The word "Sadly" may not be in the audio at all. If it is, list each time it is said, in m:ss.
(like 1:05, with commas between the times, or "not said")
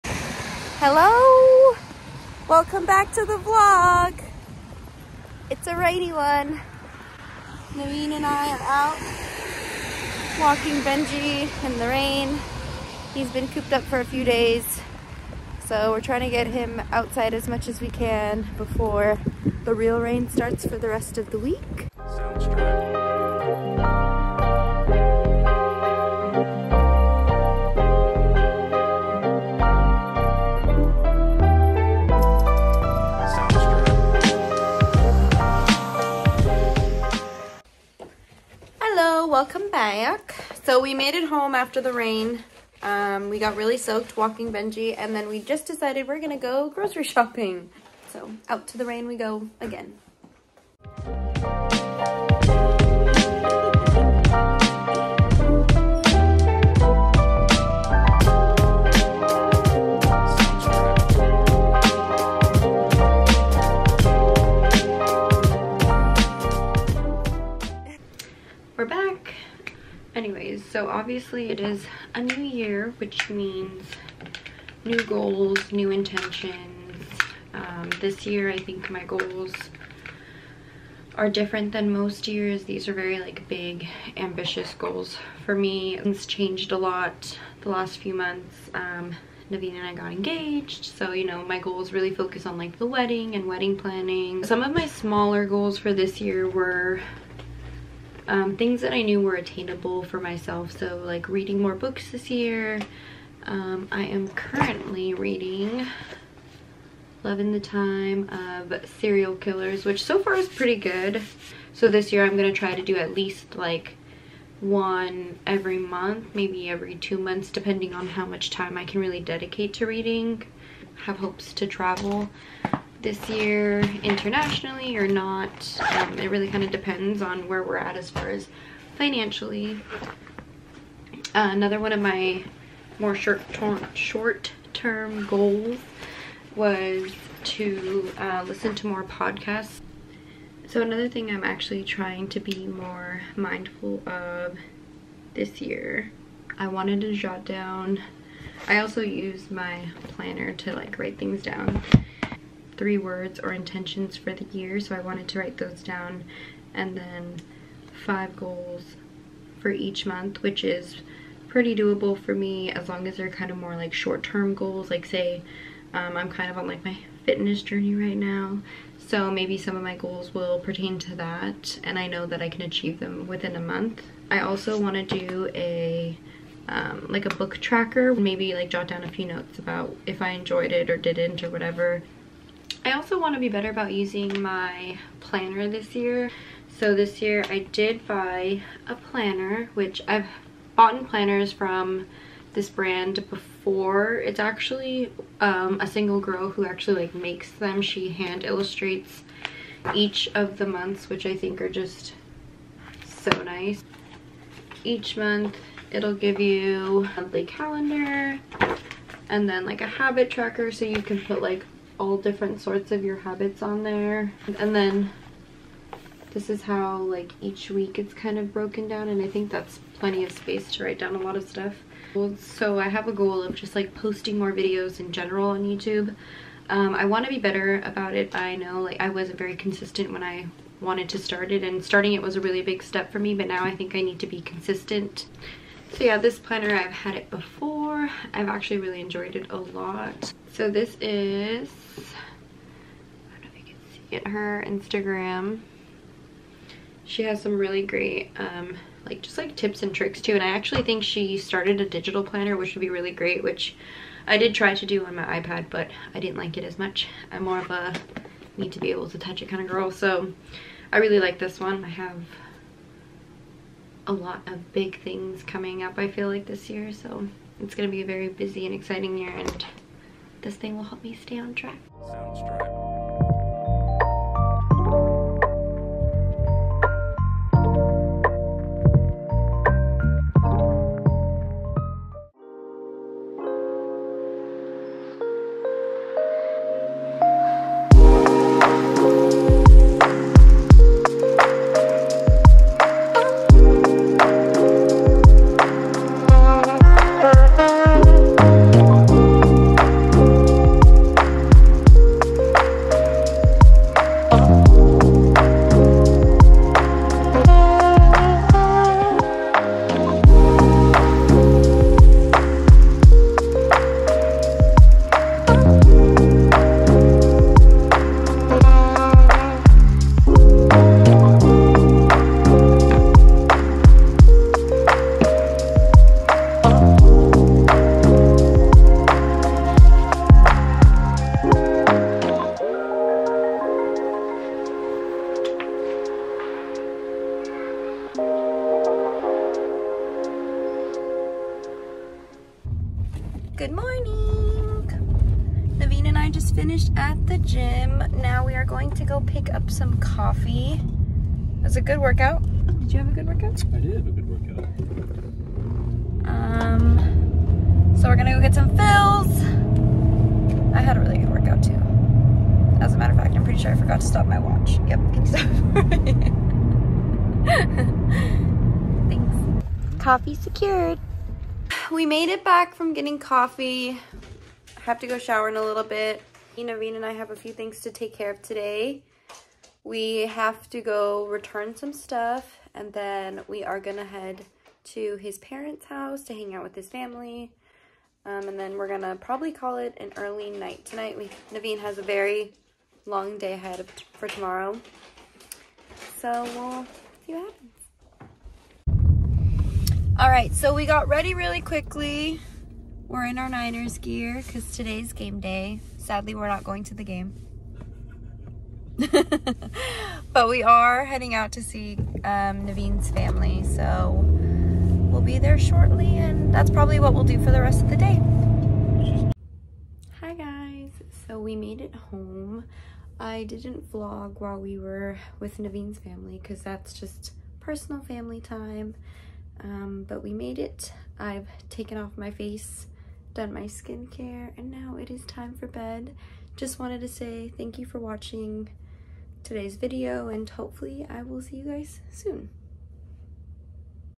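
6:46.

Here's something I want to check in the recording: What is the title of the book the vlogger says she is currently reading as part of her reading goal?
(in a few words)
Love in the Time of Serial Killers.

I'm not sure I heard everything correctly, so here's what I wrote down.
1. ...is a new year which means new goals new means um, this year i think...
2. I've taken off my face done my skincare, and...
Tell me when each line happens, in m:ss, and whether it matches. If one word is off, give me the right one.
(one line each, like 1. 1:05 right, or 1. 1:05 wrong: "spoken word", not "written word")
1. 1:11 wrong: "intentions", not "means"
2. 7:11 right.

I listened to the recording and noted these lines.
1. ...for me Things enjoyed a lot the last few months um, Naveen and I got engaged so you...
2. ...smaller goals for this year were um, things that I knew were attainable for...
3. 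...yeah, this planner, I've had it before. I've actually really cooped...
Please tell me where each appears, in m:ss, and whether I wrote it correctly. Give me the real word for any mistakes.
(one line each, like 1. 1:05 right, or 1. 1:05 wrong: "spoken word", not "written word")
1. 1:25 wrong: "changed", not "enjoyed"
2. 1:34 right
3. 3:56 wrong: "enjoyed", not "cooped".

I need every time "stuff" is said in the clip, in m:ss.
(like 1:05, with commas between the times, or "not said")
3:41, 6:21.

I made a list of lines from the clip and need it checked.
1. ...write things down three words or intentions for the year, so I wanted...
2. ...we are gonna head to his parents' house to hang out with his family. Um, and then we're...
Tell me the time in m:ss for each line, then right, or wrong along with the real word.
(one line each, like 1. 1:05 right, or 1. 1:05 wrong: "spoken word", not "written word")
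1. 2:30 right
2. 6:23 right.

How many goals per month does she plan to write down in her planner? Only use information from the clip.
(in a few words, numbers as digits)
5.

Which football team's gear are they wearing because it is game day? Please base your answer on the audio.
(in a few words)
Niners.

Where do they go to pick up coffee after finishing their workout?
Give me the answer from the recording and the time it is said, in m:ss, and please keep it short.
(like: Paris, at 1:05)
Philz, at 5:58.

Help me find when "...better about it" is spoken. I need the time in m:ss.
3:47.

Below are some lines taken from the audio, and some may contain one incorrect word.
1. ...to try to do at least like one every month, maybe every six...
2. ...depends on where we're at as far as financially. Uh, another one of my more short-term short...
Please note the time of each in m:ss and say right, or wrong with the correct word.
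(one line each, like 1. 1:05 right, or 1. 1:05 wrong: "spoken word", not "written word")
1. 1:52 wrong: "two", not "six"
2. 2:06 right.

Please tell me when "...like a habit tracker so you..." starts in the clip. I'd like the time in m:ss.
3:29.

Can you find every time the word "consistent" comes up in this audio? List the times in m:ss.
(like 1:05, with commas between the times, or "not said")
3:49, 3:54.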